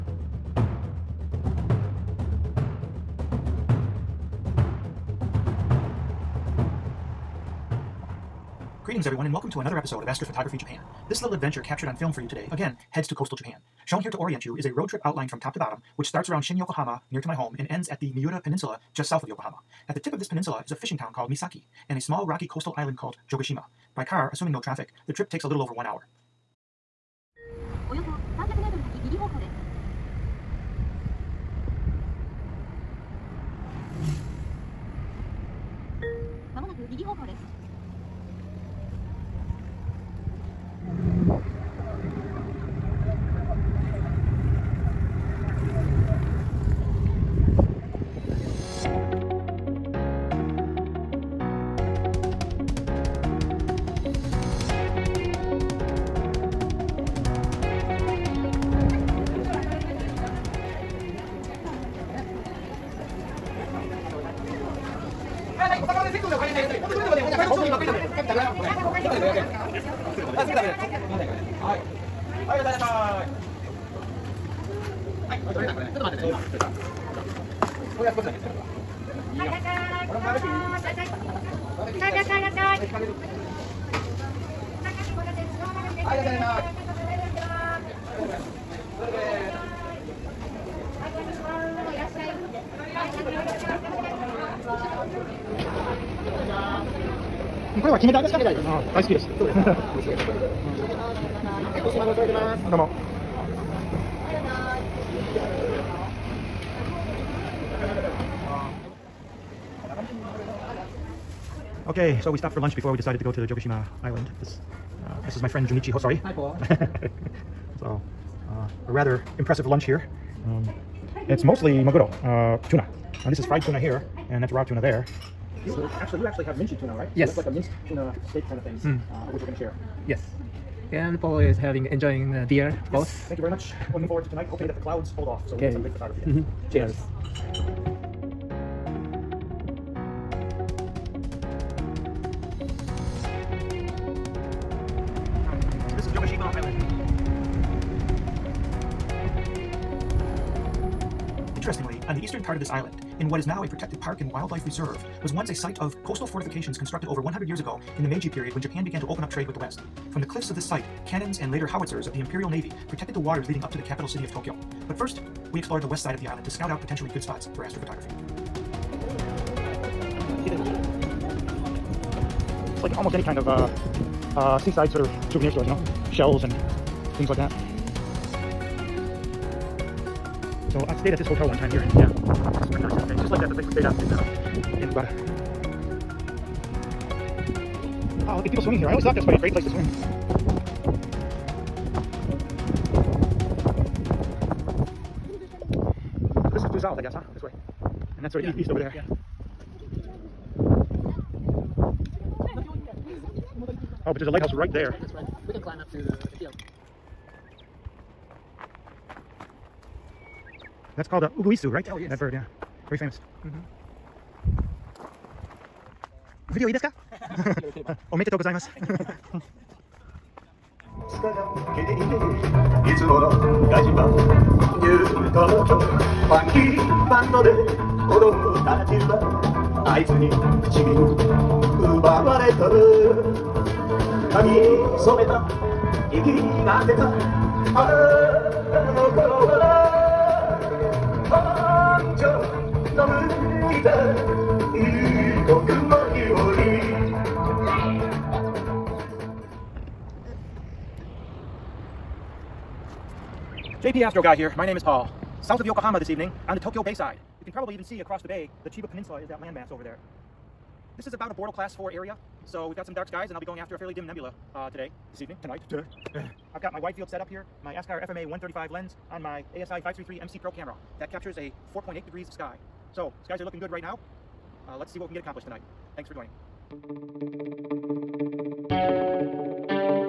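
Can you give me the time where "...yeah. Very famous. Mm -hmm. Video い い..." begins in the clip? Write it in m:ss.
3:32.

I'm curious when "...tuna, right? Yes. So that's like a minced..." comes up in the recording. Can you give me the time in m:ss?
2:06.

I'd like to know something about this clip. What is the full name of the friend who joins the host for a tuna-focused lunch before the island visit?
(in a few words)
Junichi Hosoi.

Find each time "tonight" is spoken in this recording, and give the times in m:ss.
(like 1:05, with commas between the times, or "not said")
2:14, 4:25, 4:35.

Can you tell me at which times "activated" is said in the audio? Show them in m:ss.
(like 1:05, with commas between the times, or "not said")
not said.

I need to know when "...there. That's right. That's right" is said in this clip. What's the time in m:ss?
3:24.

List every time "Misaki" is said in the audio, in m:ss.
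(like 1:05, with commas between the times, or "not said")
0:21.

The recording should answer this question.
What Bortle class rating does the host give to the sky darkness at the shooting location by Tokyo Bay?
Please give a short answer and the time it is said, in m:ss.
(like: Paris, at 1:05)
4, at 4:21.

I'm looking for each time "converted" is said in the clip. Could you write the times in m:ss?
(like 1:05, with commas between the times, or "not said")
not said.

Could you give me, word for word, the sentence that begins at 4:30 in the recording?
That captures a 4.8 degrees of sky.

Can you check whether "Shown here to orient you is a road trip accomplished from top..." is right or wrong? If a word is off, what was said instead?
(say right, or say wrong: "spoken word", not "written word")
wrong: "outlined", not "accomplished".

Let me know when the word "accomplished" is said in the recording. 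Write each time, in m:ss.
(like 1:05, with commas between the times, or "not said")
4:35.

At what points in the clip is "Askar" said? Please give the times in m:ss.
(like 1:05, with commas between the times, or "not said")
4:27.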